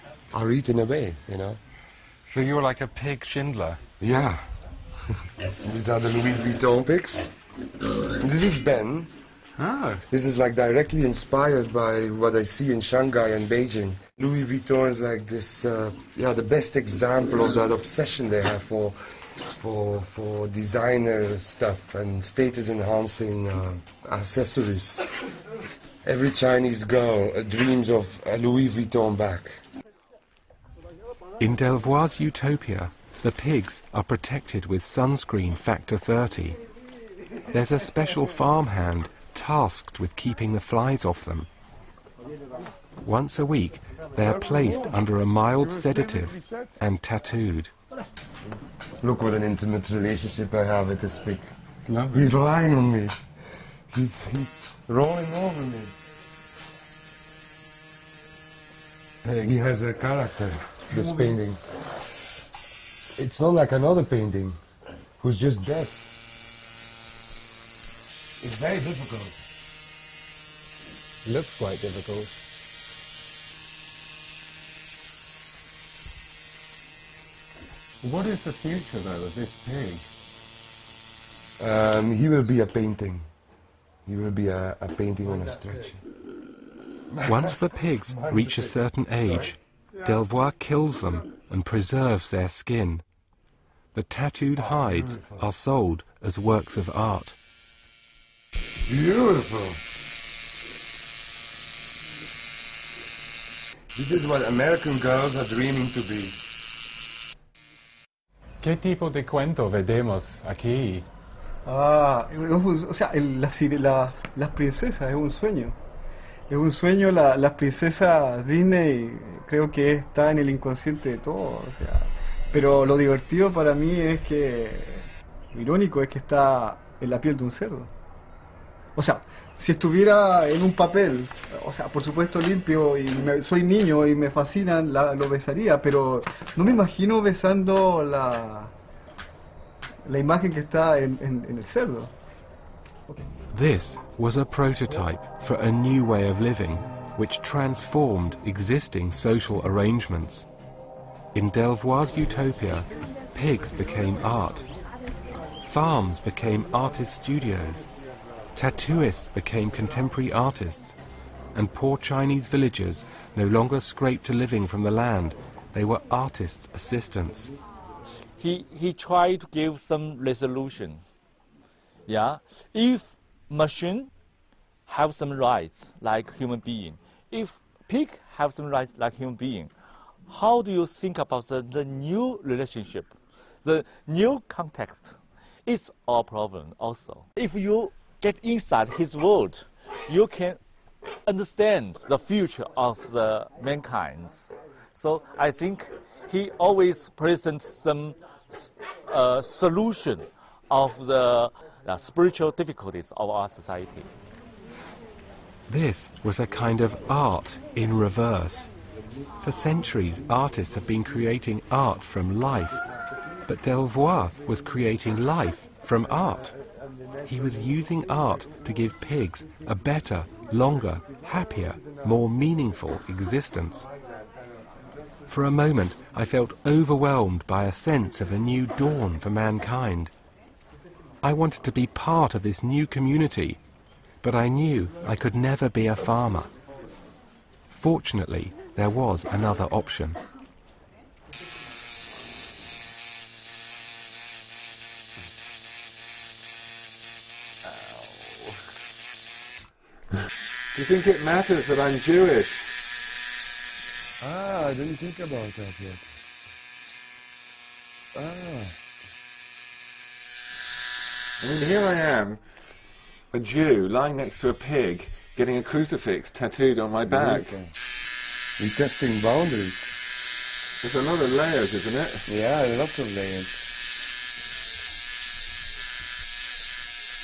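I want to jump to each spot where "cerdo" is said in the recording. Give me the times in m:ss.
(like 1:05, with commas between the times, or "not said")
2:07, 2:21.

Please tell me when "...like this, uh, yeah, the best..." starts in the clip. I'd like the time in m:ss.
0:15.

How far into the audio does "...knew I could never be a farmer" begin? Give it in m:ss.
3:54.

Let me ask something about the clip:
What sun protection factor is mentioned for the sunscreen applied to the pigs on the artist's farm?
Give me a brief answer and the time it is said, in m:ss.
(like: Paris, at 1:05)
30, at 0:35.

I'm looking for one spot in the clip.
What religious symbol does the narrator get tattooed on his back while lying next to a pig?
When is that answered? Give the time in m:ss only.
4:25.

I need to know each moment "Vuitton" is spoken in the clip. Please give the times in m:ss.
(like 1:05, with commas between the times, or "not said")
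0:06, 0:14, 0:28.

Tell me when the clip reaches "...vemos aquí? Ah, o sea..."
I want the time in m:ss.
1:49.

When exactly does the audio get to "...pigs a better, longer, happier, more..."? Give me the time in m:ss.
3:38.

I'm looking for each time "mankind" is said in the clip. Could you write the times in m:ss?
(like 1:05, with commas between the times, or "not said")
3:13, 3:49.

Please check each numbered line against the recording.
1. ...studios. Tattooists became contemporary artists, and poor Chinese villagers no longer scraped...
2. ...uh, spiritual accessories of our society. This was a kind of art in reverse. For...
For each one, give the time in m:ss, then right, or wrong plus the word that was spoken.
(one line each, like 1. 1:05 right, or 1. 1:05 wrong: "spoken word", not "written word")
1. 2:37 right
2. 3:21 wrong: "difficulties", not "accessories".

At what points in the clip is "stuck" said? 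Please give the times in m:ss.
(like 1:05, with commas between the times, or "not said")
not said.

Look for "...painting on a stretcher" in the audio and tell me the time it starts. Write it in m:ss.
1:24.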